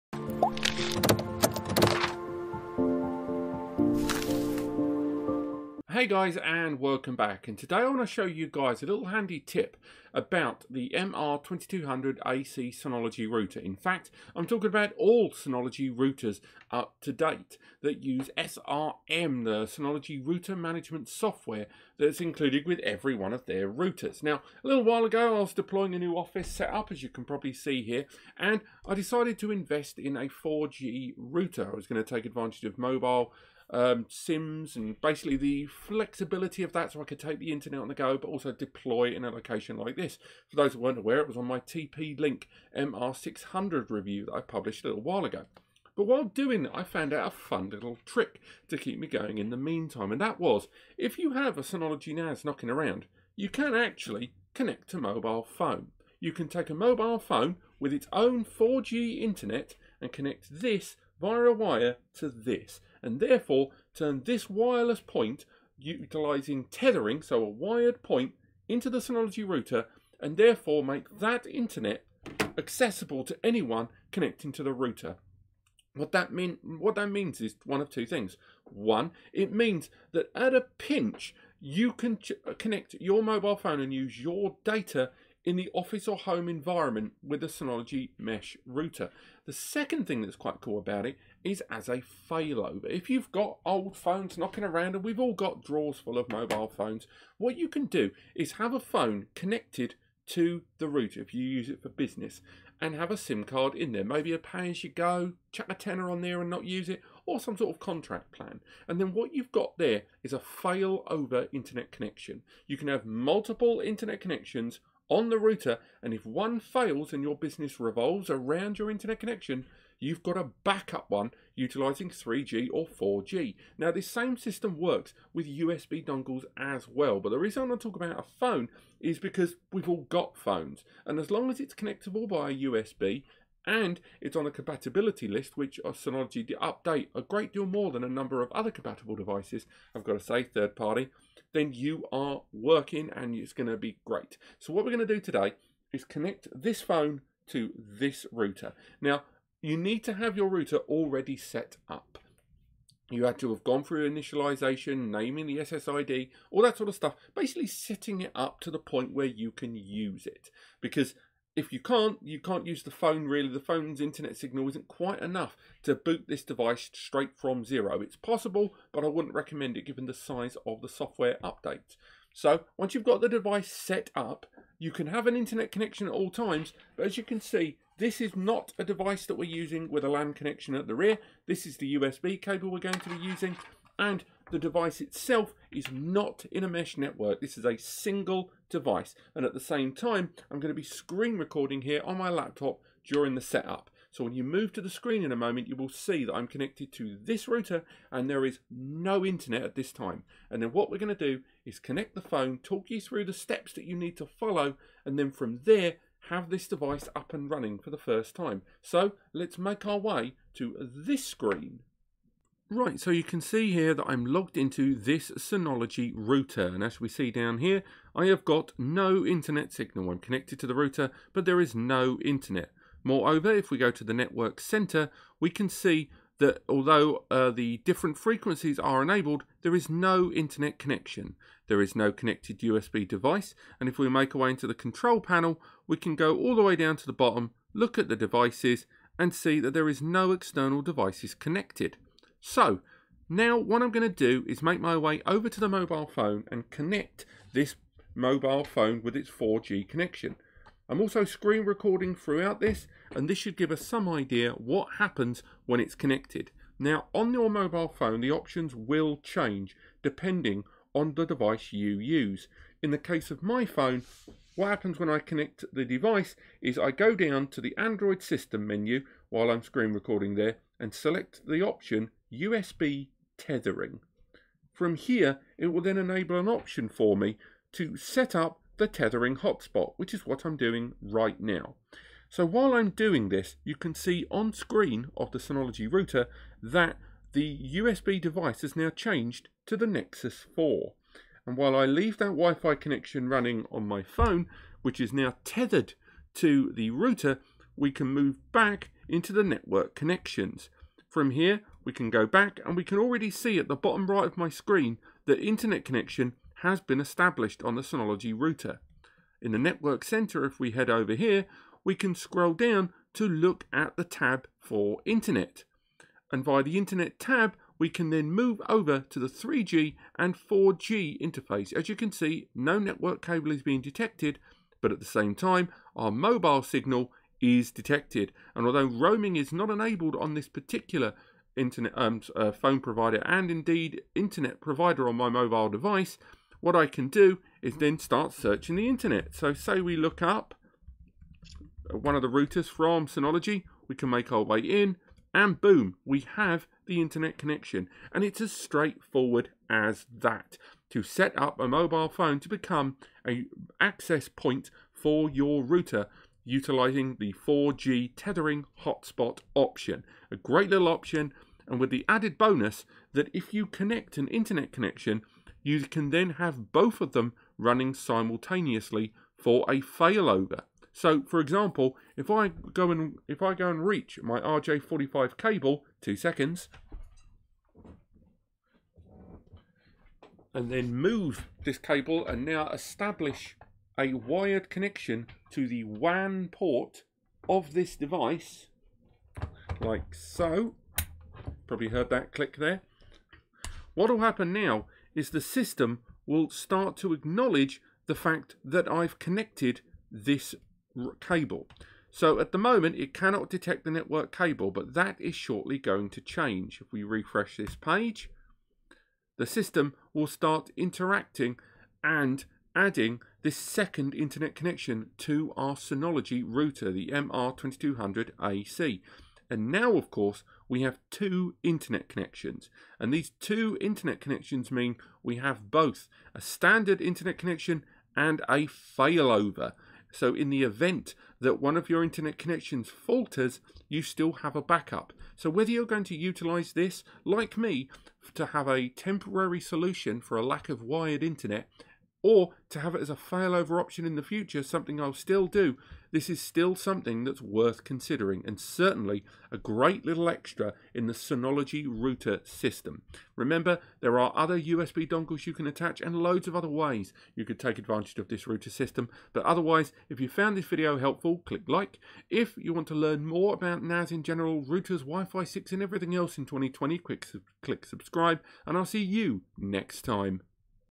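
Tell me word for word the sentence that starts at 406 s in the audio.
If we refresh this page, the system will start interacting and adding this second internet connection to our Synology router, the MR2200AC.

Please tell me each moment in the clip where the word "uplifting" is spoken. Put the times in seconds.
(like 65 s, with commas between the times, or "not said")
not said.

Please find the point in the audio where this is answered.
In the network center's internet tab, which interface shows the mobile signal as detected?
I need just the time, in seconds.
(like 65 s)
319 s.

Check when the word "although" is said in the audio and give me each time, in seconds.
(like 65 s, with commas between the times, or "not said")
226 s, 328 s.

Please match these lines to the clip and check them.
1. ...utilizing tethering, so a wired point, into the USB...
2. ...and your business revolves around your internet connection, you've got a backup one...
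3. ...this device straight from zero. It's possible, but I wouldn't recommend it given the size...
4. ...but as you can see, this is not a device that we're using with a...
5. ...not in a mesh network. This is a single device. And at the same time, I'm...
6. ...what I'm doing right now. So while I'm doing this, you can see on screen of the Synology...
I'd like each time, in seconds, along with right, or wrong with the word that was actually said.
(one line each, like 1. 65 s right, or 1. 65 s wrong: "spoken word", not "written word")
1. 65 s wrong: "Synology", not "USB"
2. 117 s right
3. 166 s right
4. 176 s right
5. 185 s right
6. 280 s right.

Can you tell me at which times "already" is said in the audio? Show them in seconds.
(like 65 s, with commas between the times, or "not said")
150 s, 302 s.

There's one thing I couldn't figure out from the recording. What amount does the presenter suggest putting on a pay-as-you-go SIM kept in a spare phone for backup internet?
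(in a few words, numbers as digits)
a tenner.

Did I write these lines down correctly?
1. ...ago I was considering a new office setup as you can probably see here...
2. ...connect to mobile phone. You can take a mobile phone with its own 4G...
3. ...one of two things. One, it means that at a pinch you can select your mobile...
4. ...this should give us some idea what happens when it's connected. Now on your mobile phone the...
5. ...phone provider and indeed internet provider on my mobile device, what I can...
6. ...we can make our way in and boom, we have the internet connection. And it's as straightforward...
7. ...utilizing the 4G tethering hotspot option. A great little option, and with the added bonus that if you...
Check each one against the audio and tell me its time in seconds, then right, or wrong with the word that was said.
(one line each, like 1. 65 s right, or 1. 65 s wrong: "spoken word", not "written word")
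1. 25 s wrong: "deploying", not "considering"
2. 54 s right
3. 77 s wrong: "connect", not "select"
4. 253 s right
5. 332 s right
6. 343 s right
7. 356 s right.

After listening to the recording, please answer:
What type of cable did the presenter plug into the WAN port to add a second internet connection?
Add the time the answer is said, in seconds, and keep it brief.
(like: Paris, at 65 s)
RJ45, at 374 s.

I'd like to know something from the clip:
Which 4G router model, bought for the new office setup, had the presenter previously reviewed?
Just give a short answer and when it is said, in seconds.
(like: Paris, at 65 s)
TP Link MR600, at 41 s.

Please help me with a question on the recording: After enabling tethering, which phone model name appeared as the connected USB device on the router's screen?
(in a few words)
Nexus 4.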